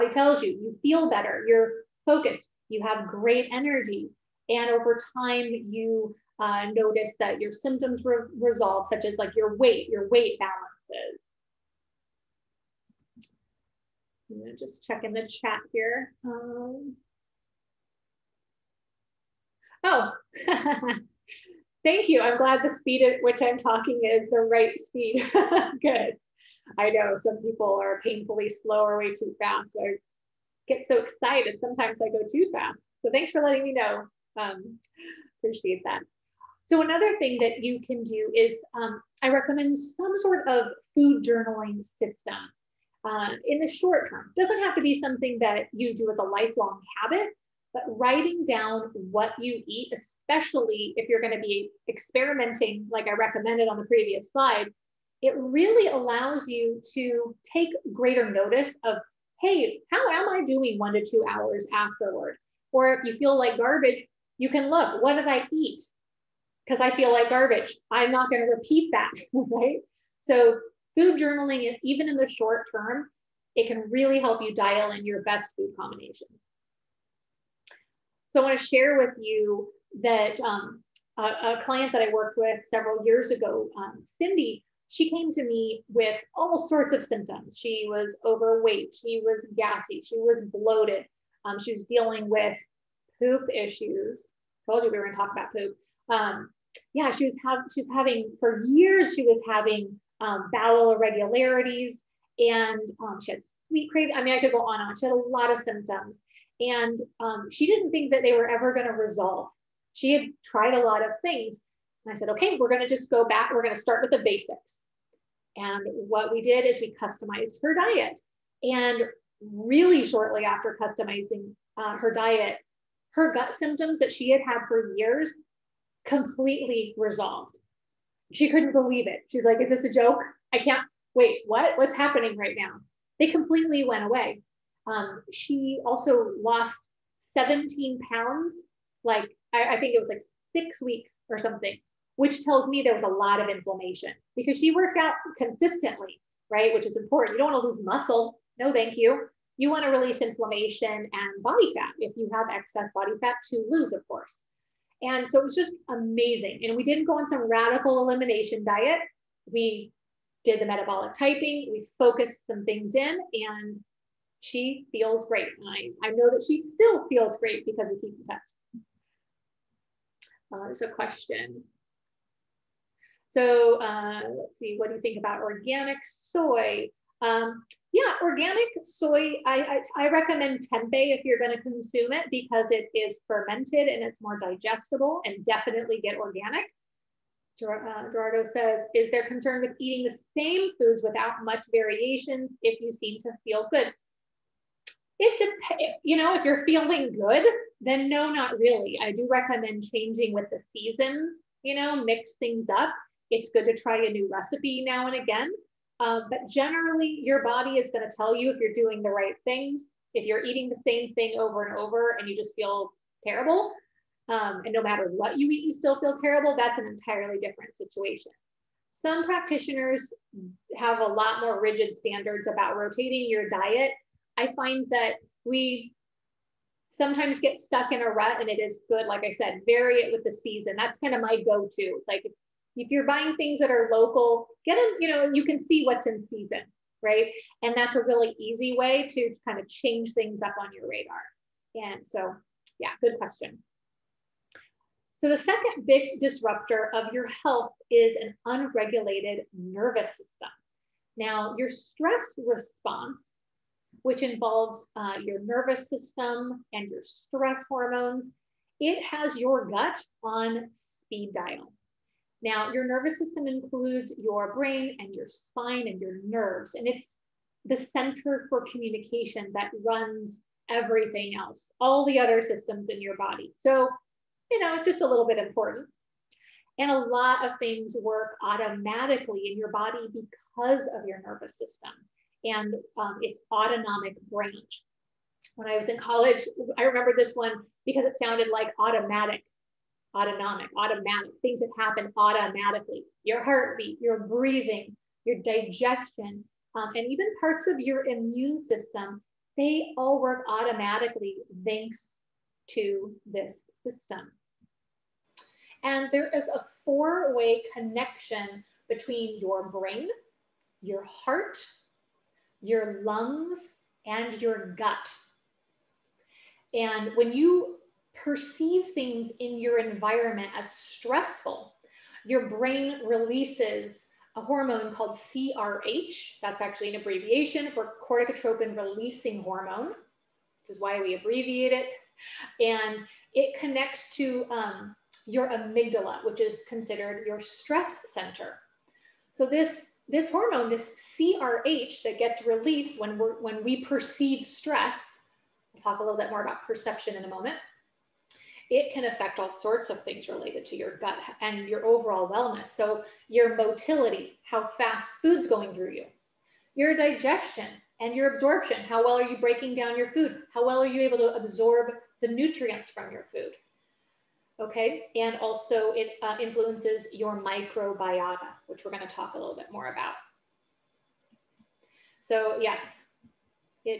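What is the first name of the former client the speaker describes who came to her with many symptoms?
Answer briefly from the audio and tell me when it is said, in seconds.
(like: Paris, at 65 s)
Cindy, at 84 s.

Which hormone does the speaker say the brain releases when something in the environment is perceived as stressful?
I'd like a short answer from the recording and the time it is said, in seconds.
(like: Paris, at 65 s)
corticotropin releasing hormone, at 328 s.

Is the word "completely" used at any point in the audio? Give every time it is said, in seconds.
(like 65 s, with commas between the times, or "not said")
126 s, 133 s.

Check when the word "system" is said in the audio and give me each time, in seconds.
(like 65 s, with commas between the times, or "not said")
41 s, 250 s, 255 s, 263 s, 272 s, 281 s, 298 s, 303 s.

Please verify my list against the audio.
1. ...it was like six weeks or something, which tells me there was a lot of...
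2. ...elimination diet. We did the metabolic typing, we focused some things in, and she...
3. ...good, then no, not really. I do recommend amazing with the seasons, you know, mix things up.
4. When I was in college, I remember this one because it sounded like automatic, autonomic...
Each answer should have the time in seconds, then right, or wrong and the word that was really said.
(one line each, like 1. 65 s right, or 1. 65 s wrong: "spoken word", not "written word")
1. 139 s right
2. 158 s right
3. 197 s wrong: "changing", not "amazing"
4. 285 s right.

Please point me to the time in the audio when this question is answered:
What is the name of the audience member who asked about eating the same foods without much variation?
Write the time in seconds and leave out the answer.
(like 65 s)
188 s.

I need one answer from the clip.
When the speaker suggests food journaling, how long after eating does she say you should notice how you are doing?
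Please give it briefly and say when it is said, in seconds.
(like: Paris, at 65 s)
1 to 2 hours, at 60 s.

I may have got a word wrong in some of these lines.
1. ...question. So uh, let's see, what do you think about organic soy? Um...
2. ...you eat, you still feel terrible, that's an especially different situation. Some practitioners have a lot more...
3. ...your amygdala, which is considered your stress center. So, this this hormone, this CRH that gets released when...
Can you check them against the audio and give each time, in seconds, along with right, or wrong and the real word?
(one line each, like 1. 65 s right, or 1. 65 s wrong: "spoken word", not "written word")
1. 170 s right
2. 215 s wrong: "entirely", not "especially"
3. 335 s right.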